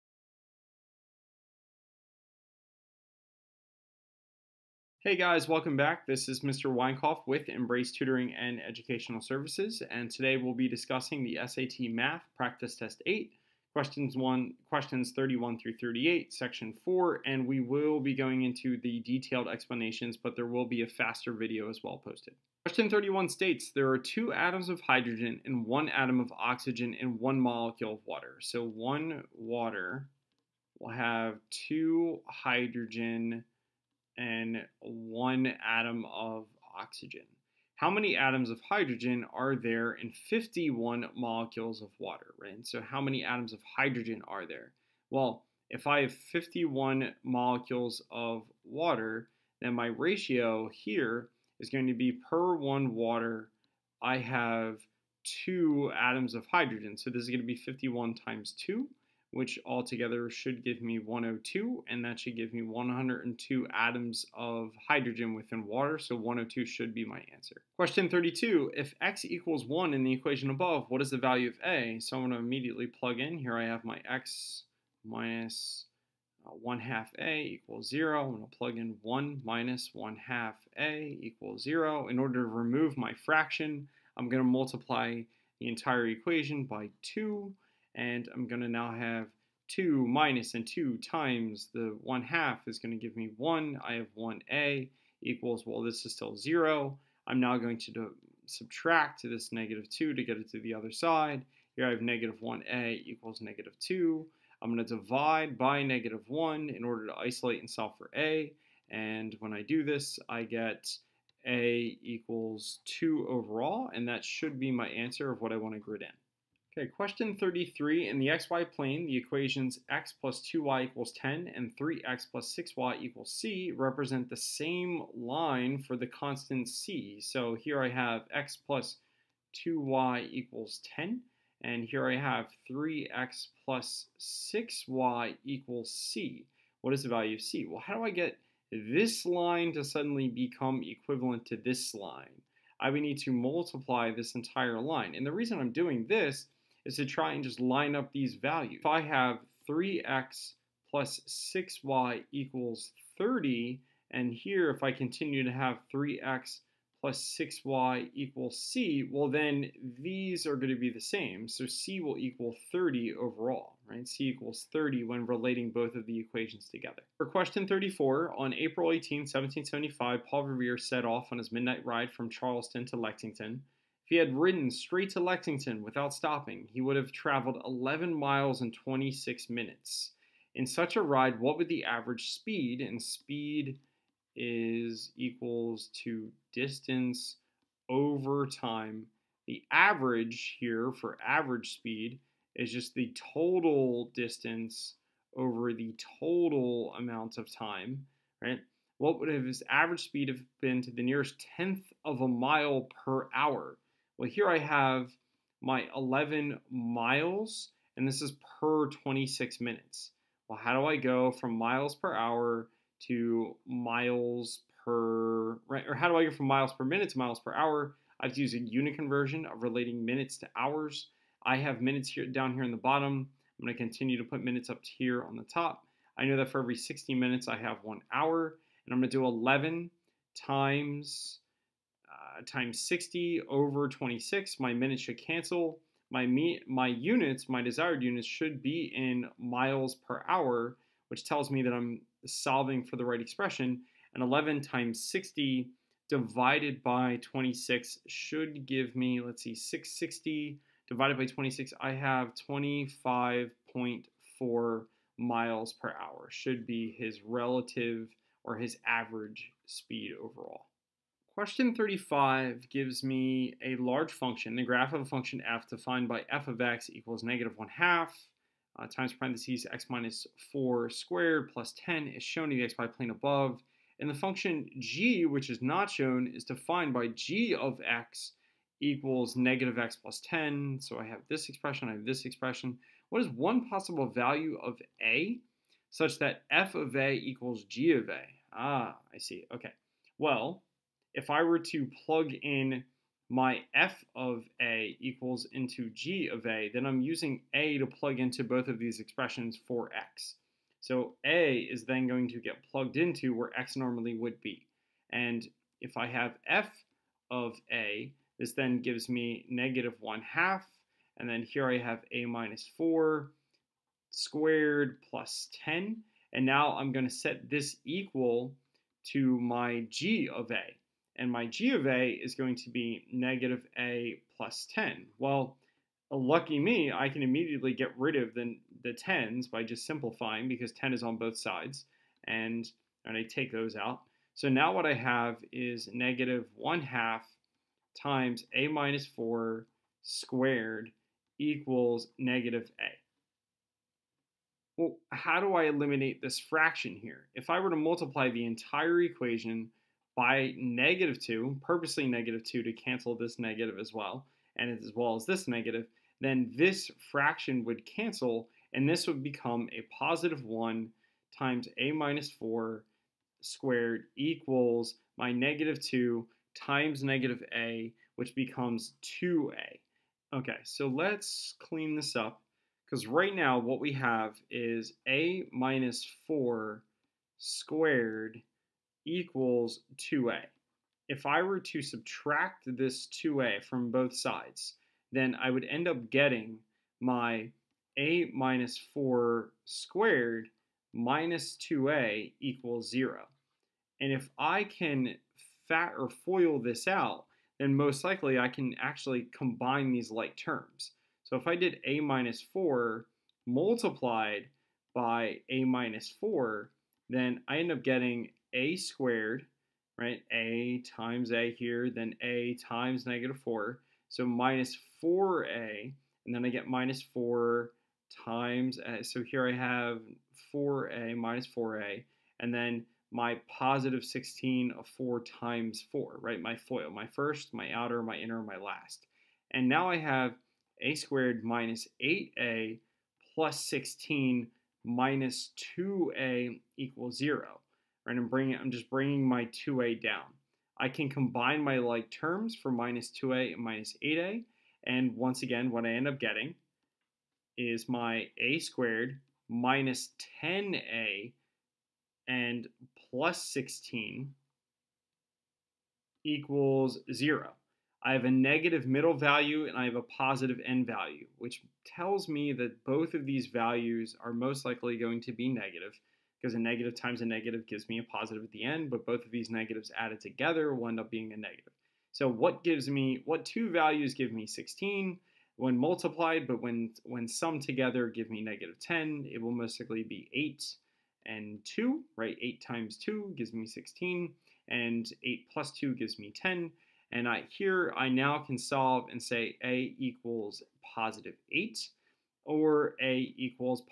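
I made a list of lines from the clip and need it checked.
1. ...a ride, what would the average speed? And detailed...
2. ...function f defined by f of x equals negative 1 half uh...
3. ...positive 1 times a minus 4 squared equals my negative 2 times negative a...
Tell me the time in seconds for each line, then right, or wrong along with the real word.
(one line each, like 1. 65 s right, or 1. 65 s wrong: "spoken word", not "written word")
1. 180 s wrong: "speed", not "detailed"
2. 265 s right
3. 359 s right.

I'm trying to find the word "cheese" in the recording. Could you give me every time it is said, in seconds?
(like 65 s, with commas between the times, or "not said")
not said.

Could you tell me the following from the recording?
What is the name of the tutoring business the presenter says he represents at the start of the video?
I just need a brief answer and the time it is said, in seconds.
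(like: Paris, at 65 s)
Embrace Tutoring and Educational Services, at 7 s.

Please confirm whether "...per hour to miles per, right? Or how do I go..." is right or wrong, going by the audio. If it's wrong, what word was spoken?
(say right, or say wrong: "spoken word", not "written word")
right.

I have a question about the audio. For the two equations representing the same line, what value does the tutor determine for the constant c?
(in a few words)
30.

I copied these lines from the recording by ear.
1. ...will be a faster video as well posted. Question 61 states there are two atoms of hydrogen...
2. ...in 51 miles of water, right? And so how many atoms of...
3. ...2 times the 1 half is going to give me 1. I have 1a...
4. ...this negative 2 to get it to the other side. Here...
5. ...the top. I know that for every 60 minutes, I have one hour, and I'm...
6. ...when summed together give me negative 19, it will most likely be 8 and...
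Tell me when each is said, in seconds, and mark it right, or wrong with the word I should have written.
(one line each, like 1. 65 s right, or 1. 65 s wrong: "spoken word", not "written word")
1. 20 s wrong: "31", not "61"
2. 39 s wrong: "molecules", not "miles"
3. 90 s right
4. 99 s right
5. 225 s right
6. 477 s wrong: "10", not "19".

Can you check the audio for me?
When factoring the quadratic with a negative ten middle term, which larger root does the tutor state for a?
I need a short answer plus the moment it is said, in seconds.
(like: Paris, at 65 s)
8, at 489 s.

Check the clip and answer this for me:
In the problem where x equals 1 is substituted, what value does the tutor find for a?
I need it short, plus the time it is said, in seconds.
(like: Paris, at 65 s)
2, at 111 s.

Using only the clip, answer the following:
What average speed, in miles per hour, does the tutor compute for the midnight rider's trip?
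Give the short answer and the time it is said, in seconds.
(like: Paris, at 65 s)
25.4 miles per hour, at 252 s.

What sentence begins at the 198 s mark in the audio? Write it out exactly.
What would have his average speed have been to the nearest tenth of a mile per hour?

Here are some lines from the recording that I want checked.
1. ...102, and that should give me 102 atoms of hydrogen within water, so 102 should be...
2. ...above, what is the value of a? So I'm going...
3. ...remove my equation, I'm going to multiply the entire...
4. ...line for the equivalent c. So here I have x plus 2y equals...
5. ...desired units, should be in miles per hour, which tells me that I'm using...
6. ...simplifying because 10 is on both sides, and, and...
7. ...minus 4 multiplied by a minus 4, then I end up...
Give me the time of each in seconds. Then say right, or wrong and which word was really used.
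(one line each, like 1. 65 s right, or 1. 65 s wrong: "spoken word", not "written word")
1. 60 s right
2. 70 s right
3. 82 s wrong: "fraction", not "equation"
4. 125 s wrong: "constant", not "equivalent"
5. 237 s wrong: "solving", not "using"
6. 329 s right
7. 402 s right.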